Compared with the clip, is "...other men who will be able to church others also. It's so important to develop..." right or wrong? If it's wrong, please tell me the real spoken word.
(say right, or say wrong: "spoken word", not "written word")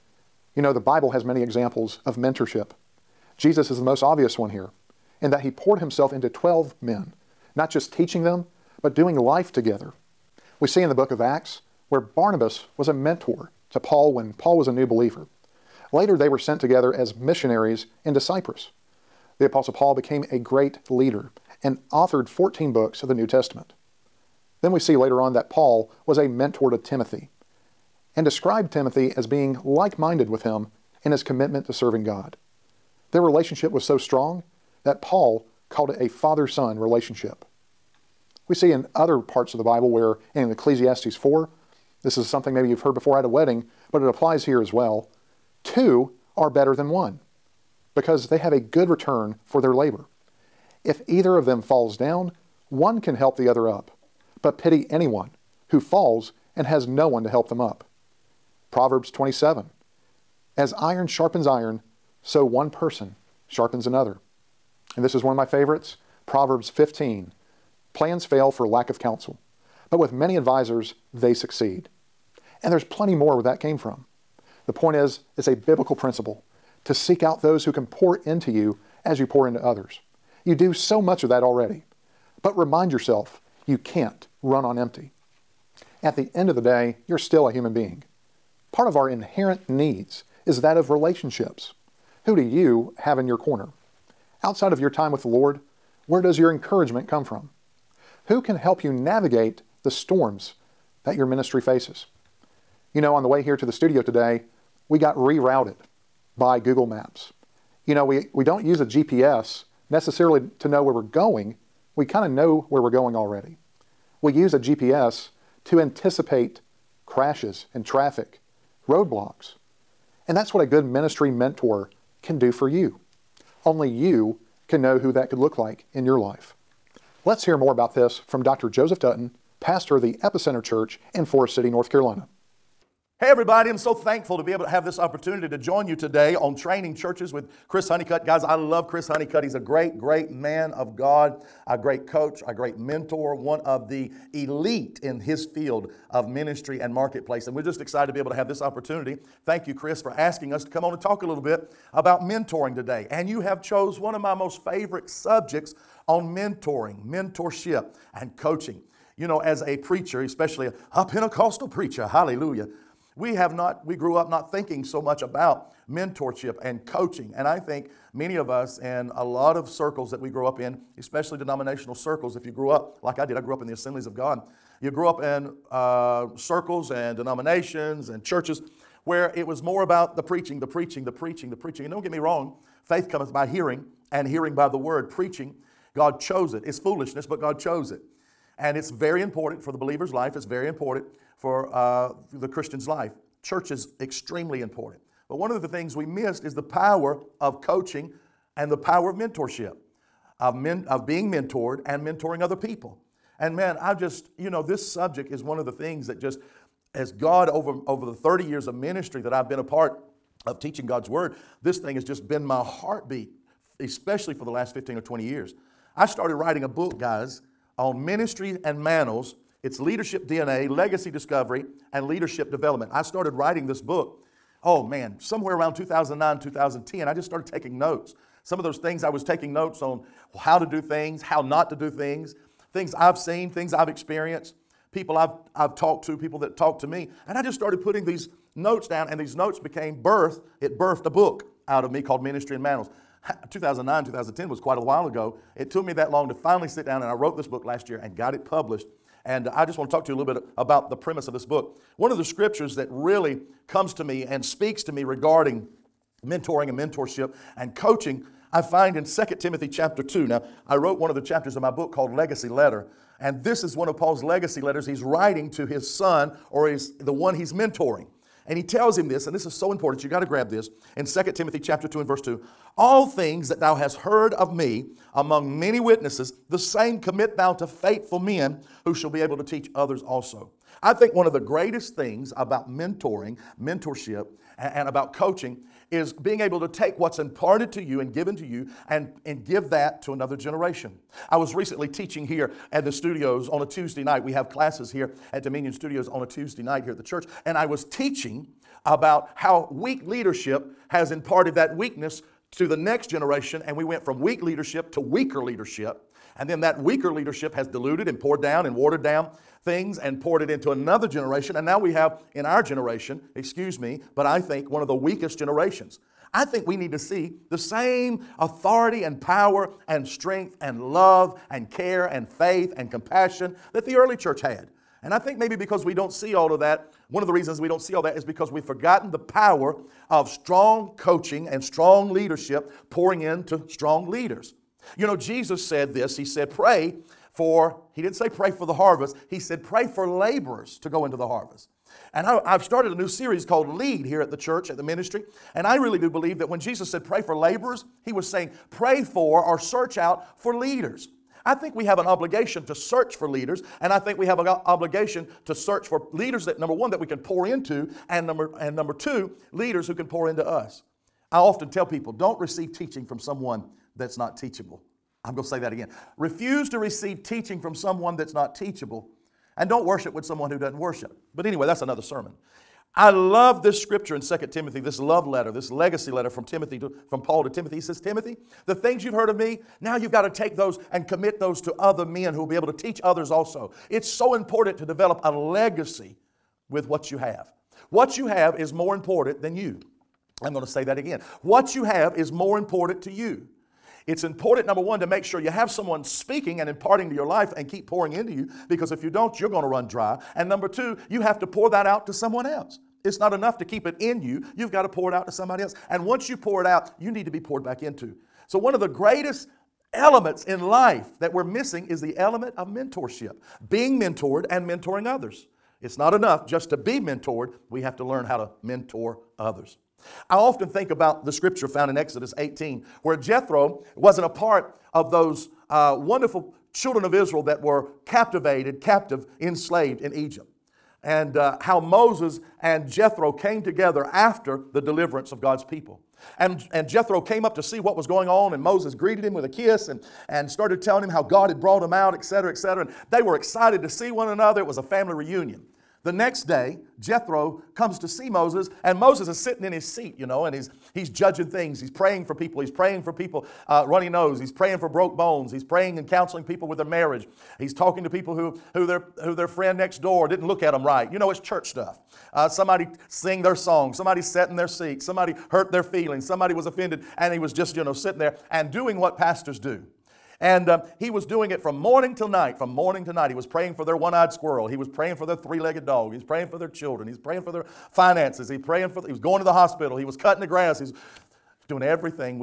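wrong: "teach", not "church".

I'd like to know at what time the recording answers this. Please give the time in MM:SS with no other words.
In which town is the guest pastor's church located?
02:11.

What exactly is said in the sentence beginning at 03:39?
It's leadership DNA, legacy discovery, and leadership development.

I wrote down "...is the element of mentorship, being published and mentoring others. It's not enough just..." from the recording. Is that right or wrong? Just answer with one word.
wrong.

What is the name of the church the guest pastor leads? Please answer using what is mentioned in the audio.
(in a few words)
Epicenter Church.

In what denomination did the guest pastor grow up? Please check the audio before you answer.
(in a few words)
Assemblies of God.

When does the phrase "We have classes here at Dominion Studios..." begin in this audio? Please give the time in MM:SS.
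04:54.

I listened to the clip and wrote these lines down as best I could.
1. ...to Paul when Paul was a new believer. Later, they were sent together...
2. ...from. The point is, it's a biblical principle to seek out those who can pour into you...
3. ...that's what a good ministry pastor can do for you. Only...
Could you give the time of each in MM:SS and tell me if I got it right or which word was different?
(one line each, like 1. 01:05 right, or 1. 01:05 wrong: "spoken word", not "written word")
1. 00:13 right
2. 01:13 right
3. 02:00 wrong: "mentor", not "pastor".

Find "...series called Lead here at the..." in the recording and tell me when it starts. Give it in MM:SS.
05:43.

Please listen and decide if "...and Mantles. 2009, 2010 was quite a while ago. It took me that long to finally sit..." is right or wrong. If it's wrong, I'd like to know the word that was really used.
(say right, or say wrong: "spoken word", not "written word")
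right.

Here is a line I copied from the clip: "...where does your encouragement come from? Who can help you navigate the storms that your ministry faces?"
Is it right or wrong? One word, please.
right.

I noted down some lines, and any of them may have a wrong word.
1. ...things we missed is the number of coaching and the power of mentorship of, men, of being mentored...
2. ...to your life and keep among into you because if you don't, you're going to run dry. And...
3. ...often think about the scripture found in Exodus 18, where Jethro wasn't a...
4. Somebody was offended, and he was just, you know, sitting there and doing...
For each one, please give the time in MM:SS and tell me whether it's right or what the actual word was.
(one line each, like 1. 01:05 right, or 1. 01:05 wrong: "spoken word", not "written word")
1. 03:15 wrong: "power", not "number"
2. 06:37 wrong: "pouring", not "among"
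3. 07:00 right
4. 07:46 right.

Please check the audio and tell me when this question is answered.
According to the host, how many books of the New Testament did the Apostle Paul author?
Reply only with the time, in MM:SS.
00:22.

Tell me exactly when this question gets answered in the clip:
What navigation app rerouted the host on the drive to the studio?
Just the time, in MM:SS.
01:46.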